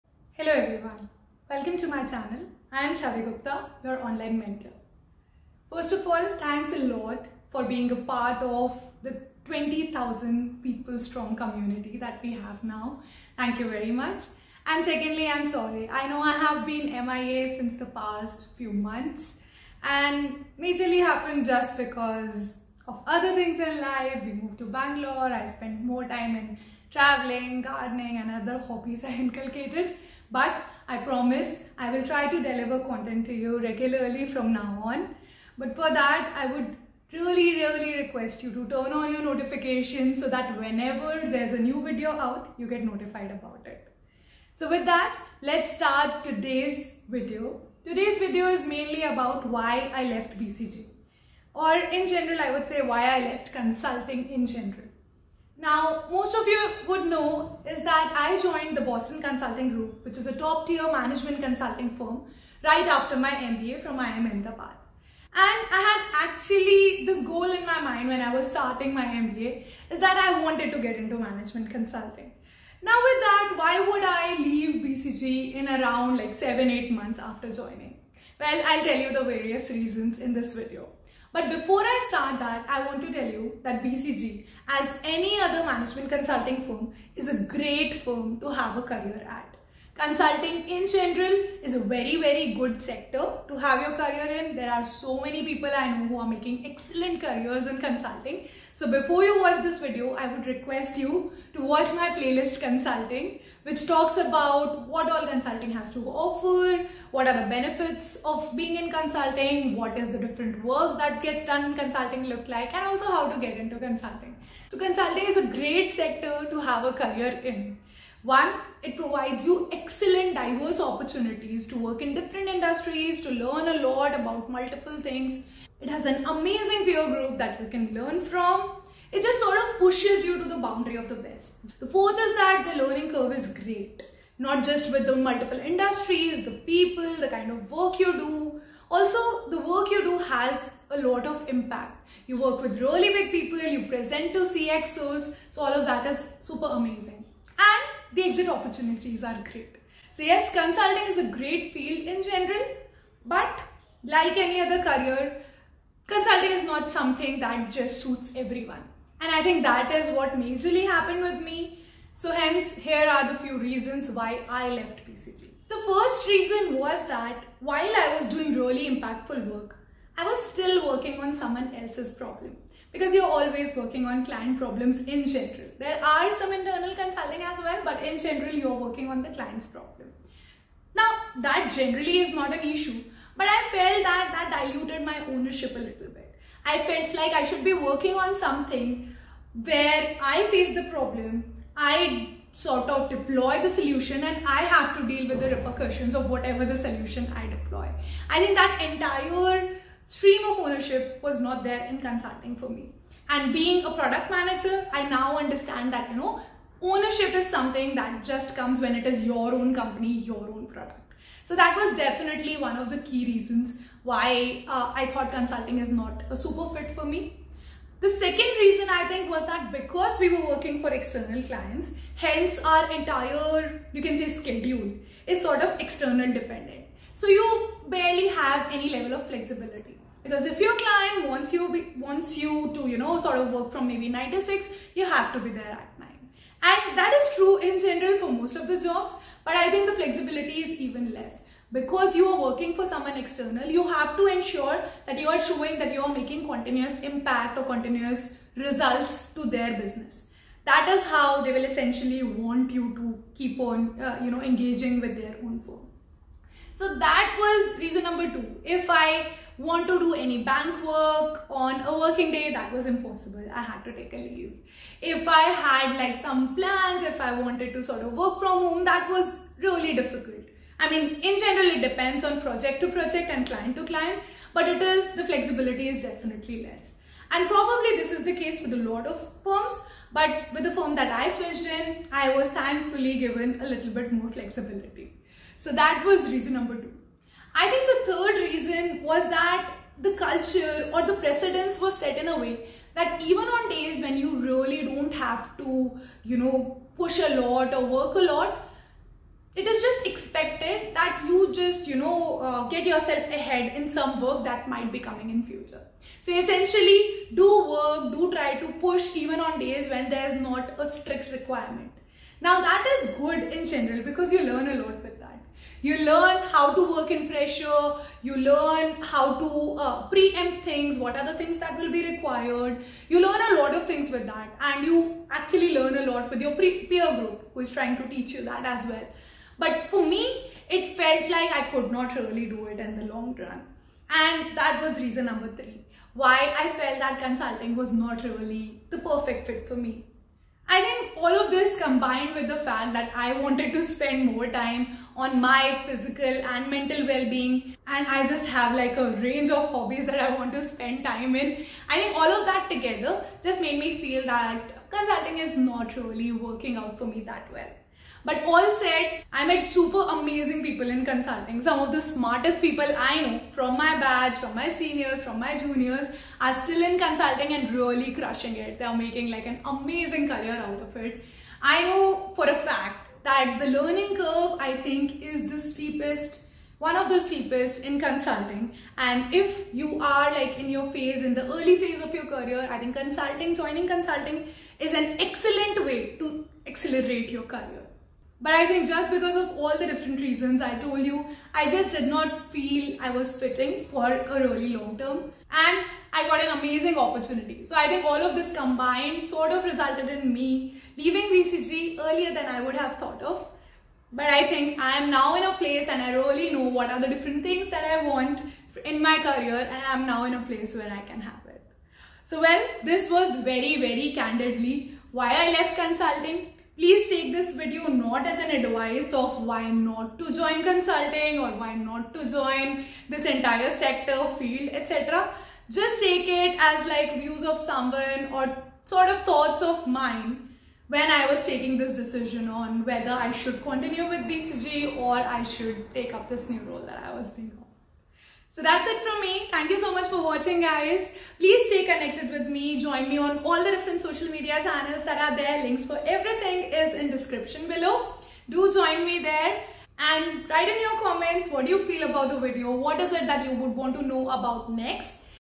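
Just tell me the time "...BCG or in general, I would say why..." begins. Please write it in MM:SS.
00:50.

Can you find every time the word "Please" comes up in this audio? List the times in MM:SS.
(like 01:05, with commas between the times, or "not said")
06:56, 07:21.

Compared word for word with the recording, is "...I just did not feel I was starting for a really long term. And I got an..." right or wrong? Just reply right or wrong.
wrong.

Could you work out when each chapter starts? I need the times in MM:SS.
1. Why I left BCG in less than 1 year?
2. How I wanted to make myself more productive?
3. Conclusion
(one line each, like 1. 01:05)
1. 00:56
2. 05:45
3. 06:14.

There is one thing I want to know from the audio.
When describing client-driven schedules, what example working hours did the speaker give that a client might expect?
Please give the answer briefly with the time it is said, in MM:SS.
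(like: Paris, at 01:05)
9 to 6, at 03:54.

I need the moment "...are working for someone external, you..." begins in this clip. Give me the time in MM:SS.
04:02.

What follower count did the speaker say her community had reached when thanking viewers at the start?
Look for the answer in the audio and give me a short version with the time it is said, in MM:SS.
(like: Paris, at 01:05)
20,000, at 00:09.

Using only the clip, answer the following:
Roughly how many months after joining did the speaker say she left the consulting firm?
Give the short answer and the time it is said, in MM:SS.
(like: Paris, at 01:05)
7-8 months, at 01:16.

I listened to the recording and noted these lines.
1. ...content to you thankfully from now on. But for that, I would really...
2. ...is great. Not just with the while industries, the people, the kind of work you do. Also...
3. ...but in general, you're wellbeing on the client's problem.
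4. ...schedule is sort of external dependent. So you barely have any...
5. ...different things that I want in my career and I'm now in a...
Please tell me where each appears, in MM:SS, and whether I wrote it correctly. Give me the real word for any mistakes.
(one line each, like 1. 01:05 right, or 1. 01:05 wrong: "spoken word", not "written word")
1. 00:32 wrong: "regularly", not "thankfully"
2. 02:13 wrong: "multiple", not "while"
3. 02:57 wrong: "working", not "wellbeing"
4. 03:44 right
5. 06:47 right.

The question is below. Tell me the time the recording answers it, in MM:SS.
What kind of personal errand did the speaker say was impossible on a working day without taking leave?
04:20.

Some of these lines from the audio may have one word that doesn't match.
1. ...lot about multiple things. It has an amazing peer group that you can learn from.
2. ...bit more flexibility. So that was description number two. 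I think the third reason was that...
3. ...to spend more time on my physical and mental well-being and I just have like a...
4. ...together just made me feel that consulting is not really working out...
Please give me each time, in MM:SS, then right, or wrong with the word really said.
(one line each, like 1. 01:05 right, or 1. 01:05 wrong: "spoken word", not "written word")
1. 02:03 right
2. 04:43 wrong: "reason", not "description"
3. 05:43 right
4. 05:52 right.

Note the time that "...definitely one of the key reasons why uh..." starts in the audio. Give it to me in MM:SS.
03:31.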